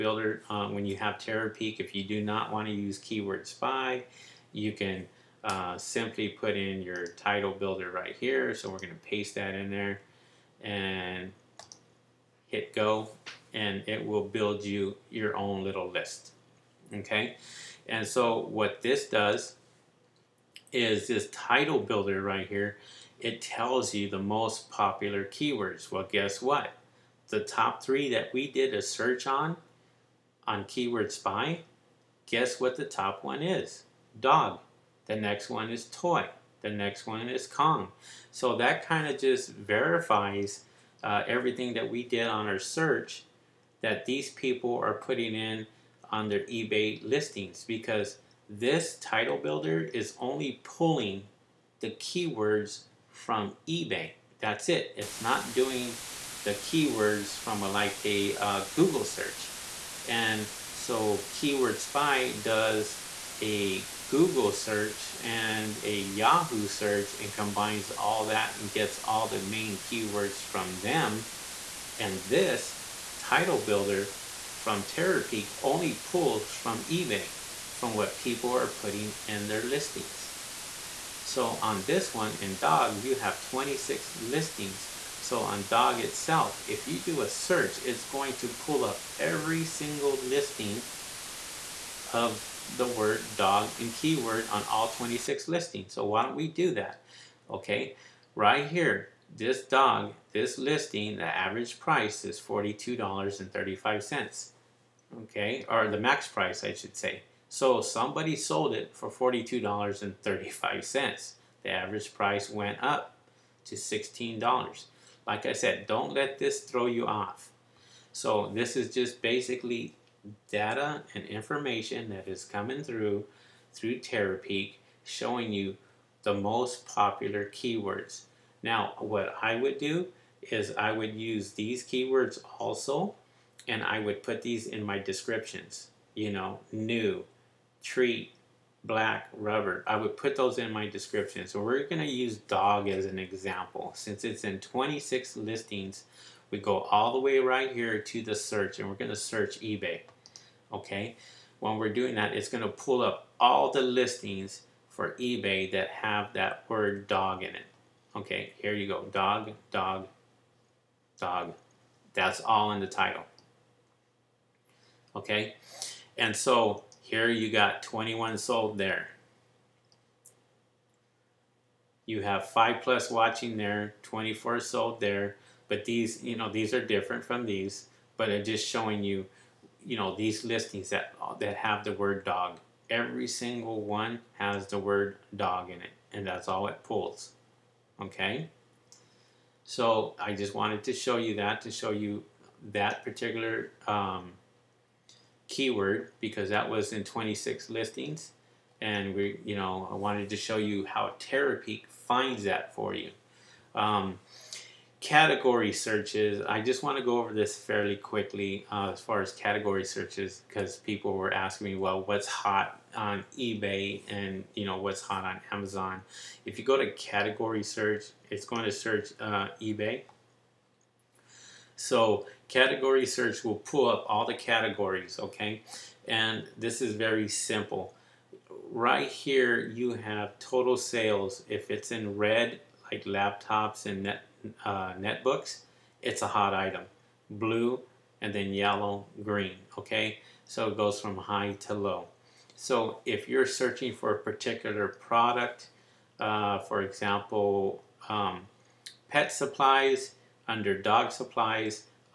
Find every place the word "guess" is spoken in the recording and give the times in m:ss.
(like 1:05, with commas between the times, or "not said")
0:26, 0:32.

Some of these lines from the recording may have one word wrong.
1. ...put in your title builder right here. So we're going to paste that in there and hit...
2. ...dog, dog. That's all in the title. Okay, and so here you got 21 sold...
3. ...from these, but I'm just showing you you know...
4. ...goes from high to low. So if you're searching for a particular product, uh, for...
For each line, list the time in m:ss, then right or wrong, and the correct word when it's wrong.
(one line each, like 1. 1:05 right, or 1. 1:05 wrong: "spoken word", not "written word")
1. 0:06 right
2. 2:39 right
3. 2:57 right
4. 4:00 right.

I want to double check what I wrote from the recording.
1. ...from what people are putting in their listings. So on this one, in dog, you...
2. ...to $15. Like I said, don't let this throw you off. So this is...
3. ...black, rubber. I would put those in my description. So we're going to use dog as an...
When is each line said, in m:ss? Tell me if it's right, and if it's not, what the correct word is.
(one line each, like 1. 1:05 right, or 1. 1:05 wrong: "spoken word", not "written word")
1. 1:17 right
2. 1:53 wrong: "16", not "15"
3. 2:18 right.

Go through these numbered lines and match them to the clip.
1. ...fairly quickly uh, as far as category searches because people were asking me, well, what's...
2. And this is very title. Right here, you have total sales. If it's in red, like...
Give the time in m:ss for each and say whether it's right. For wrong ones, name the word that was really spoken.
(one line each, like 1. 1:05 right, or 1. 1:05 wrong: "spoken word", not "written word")
1. 3:27 right
2. 3:46 wrong: "simple", not "title".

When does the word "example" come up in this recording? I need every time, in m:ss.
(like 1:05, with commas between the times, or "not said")
2:23, 4:06.